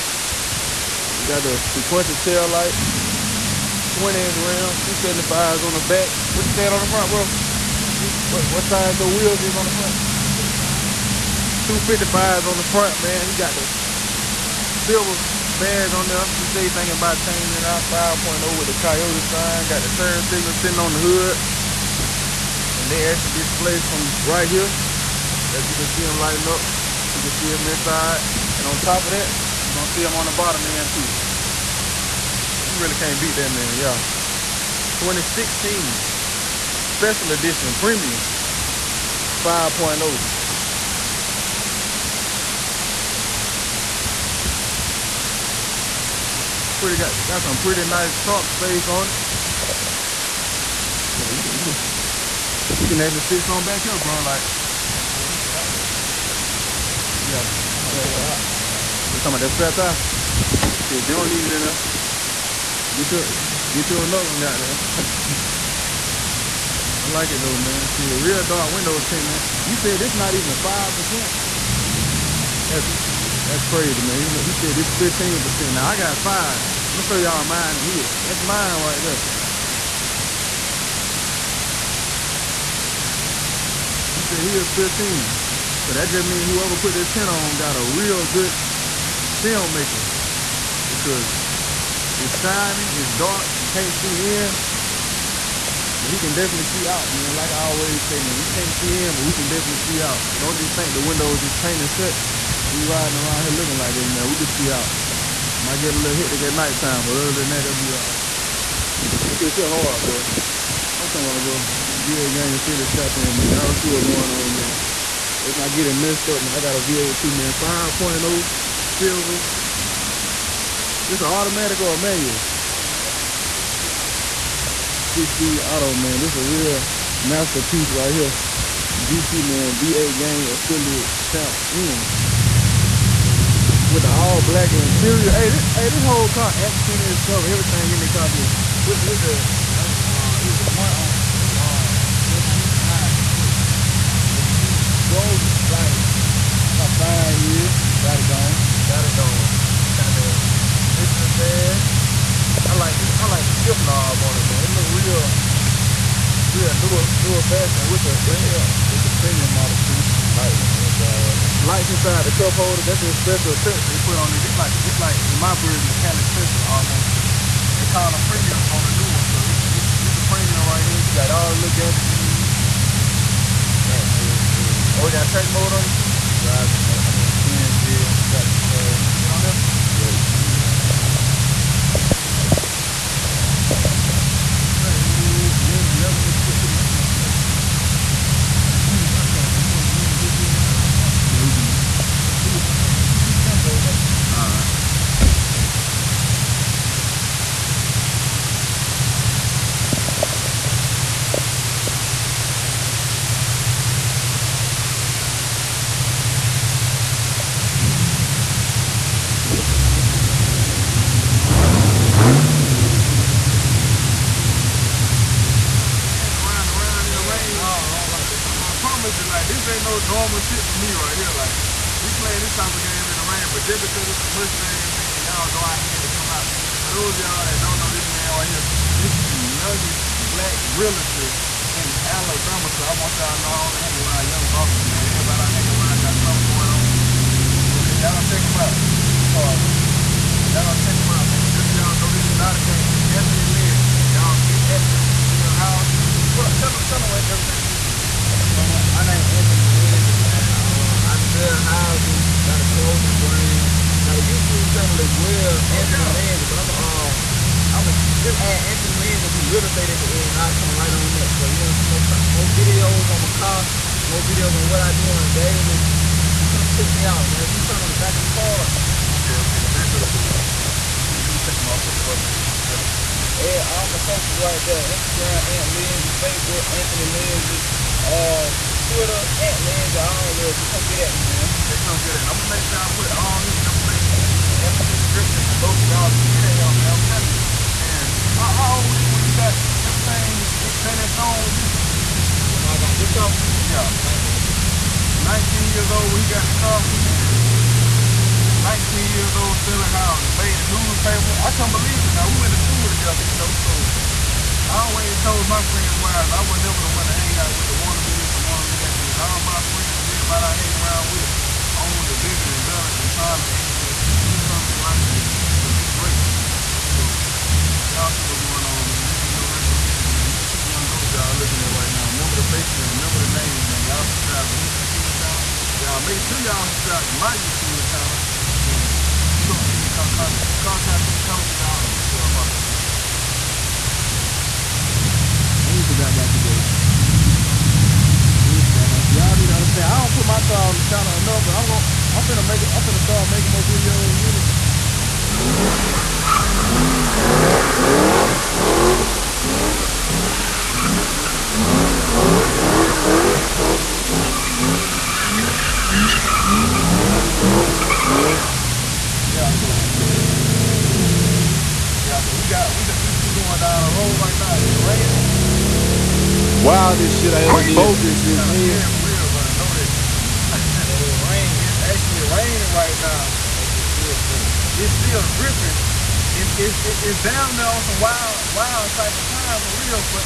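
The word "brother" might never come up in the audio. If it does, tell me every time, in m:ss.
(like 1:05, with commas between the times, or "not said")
3:59, 6:09.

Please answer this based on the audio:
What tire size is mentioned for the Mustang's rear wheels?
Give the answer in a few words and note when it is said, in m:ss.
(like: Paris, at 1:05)
275s, at 0:04.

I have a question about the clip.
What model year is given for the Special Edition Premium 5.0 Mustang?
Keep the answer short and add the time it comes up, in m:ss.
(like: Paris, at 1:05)
2016, at 0:34.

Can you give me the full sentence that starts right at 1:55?
Let's not get it messed up, man.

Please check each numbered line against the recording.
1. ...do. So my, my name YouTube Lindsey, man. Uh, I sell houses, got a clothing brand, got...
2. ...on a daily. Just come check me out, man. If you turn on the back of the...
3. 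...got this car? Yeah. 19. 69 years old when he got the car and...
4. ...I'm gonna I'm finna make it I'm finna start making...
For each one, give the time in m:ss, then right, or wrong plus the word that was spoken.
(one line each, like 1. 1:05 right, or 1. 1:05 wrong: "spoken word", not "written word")
1. 4:07 wrong: "Anthony", not "YouTube"
2. 4:25 right
3. 4:52 wrong: "19", not "69"
4. 5:41 right.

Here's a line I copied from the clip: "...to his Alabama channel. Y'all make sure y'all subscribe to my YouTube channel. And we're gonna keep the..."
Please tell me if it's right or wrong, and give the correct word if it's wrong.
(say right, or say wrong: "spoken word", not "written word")
wrong: "YouTube", not "Alabama".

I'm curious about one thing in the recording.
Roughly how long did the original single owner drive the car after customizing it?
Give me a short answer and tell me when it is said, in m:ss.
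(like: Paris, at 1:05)
About 5 years, at 2:26.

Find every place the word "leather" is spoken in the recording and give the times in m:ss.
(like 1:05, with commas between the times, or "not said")
3:05.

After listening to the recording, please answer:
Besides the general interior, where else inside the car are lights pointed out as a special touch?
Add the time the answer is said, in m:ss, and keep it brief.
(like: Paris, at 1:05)
The cup holder, at 2:42.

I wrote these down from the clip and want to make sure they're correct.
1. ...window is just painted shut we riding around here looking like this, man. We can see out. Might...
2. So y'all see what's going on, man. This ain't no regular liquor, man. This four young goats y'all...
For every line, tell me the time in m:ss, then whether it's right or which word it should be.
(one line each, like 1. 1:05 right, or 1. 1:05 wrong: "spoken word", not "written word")
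1. 1:41 right
2. 5:16 wrong: "two", not "four".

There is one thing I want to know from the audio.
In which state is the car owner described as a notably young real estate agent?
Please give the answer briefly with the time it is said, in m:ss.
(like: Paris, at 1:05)
Alabama, at 3:52.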